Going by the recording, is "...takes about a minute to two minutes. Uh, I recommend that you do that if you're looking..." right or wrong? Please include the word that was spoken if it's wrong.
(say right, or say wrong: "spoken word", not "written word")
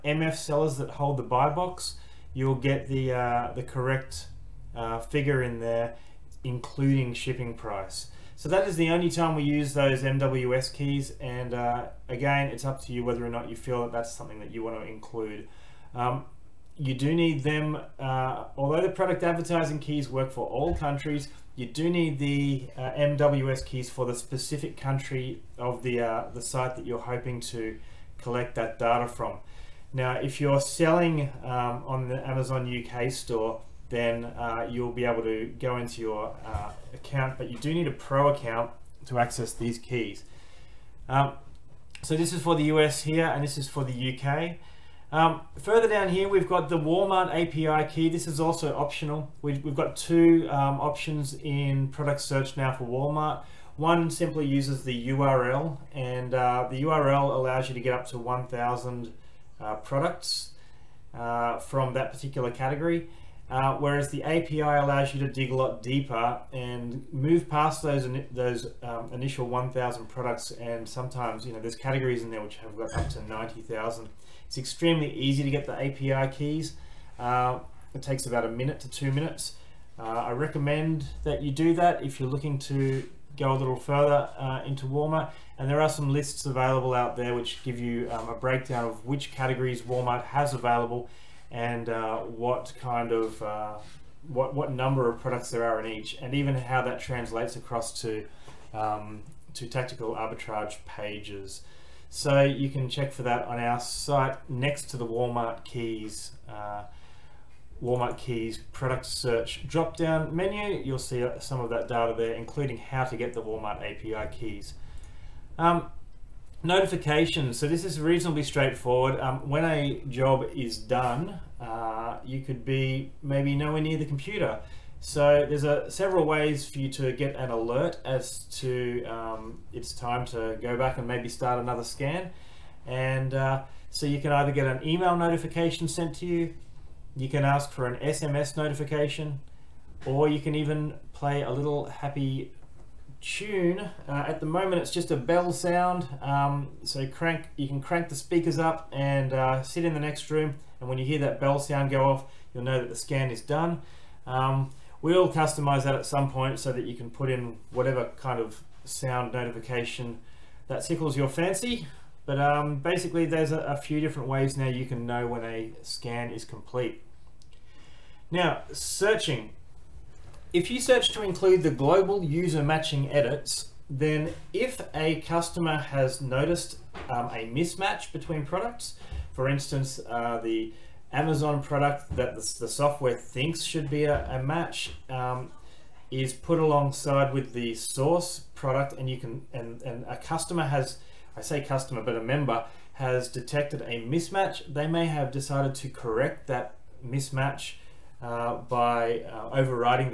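right.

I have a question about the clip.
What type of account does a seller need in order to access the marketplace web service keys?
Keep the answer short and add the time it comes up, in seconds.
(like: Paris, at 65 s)
pro account, at 37 s.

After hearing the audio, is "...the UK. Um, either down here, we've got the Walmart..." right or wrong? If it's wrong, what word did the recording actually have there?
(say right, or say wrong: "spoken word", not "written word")
wrong: "further", not "either".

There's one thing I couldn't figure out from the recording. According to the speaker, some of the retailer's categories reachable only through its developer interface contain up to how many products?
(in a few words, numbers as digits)
90,000.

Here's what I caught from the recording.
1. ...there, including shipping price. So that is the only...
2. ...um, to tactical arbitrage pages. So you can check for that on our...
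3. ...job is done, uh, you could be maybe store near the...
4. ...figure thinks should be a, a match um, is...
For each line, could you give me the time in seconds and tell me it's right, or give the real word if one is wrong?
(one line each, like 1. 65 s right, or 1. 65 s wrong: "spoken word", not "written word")
1. 5 s right
2. 98 s right
3. 120 s wrong: "nowhere", not "store"
4. 182 s wrong: "software", not "figure".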